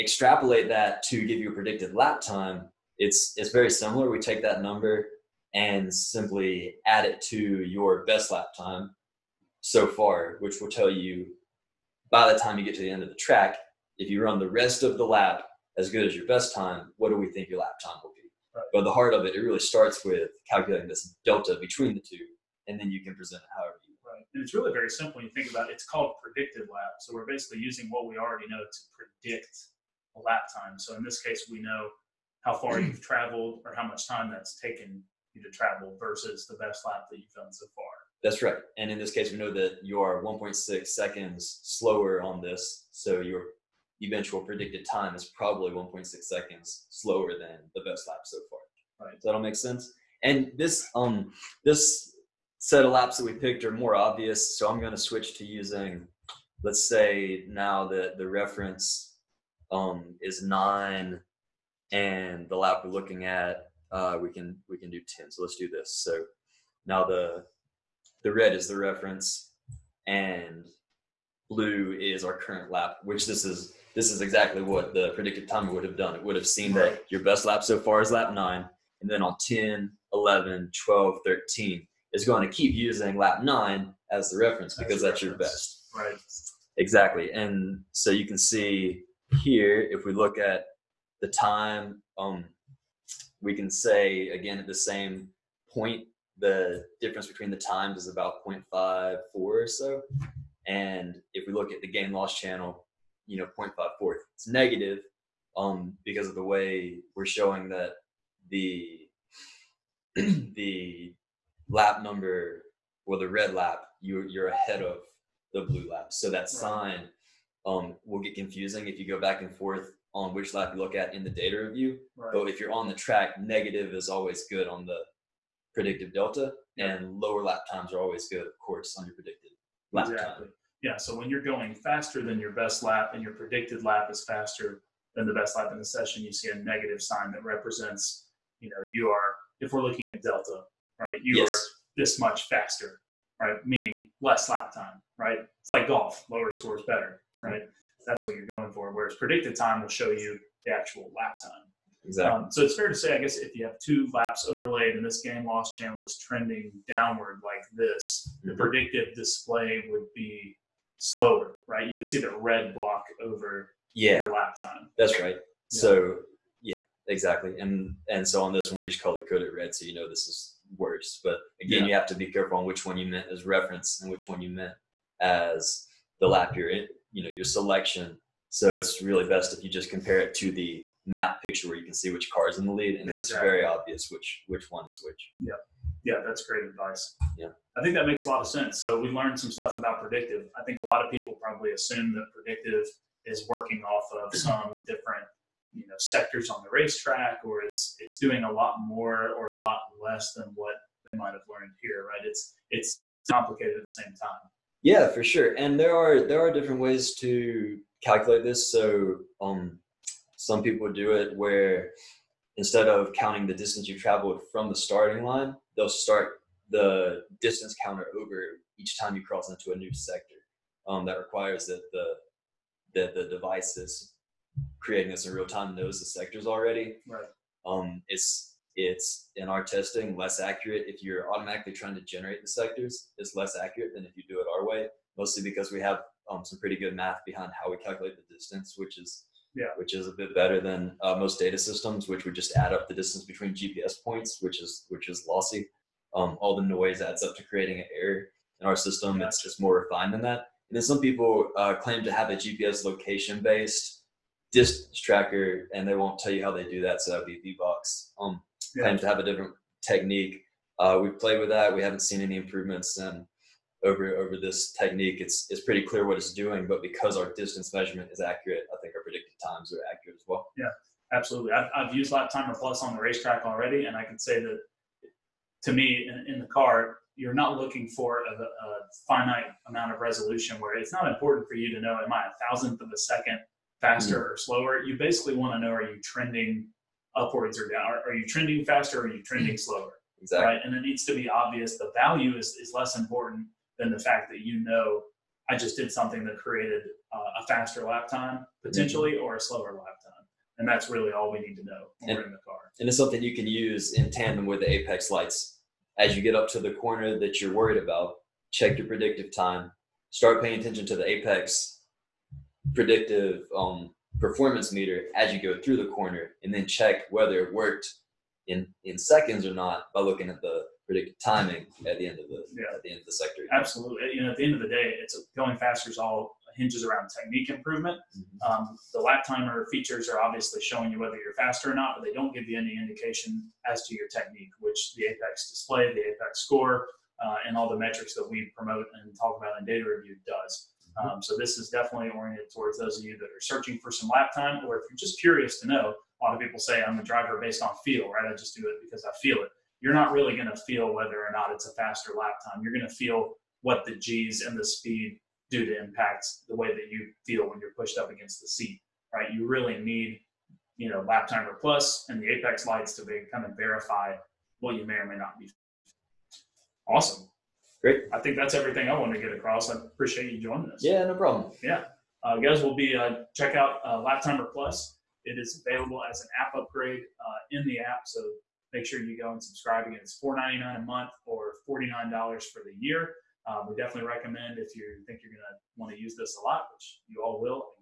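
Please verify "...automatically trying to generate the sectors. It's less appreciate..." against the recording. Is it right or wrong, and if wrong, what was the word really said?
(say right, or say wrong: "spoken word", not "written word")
wrong: "accurate", not "appreciate".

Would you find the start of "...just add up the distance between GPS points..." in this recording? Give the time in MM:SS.
04:02.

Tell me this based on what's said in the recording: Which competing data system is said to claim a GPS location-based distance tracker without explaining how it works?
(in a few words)
V-Box.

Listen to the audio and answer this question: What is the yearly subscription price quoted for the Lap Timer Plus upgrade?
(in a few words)
$49.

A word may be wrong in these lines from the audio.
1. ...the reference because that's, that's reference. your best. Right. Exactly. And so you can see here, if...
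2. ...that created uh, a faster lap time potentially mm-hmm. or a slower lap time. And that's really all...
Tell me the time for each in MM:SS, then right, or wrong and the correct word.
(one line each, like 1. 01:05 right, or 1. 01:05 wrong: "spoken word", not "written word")
1. 01:24 right
2. 04:56 right.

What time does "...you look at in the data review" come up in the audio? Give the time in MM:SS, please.
02:00.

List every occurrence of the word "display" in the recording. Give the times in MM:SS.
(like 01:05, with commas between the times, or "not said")
02:39, 05:35.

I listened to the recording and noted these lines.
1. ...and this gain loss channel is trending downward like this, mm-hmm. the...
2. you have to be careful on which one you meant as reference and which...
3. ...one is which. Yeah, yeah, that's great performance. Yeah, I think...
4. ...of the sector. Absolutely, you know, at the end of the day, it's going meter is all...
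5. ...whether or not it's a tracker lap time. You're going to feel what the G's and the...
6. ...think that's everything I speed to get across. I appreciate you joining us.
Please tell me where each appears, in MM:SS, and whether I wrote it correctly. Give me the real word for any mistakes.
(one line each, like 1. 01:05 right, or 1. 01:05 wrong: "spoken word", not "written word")
1. 02:34 right
2. 02:51 right
3. 03:04 wrong: "advice", not "performance"
4. 05:22 wrong: "faster", not "meter"
5. 05:50 wrong: "faster", not "tracker"
6. 06:08 wrong: "wanted", not "speed".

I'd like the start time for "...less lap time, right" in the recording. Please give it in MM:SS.
02:24.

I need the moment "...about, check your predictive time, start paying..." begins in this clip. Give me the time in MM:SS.
05:07.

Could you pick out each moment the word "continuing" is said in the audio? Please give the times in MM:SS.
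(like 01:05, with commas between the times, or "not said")
not said.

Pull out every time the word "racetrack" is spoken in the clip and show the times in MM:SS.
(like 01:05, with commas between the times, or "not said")
03:16, 04:33.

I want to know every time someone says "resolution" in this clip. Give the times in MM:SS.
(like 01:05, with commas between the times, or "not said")
04:39.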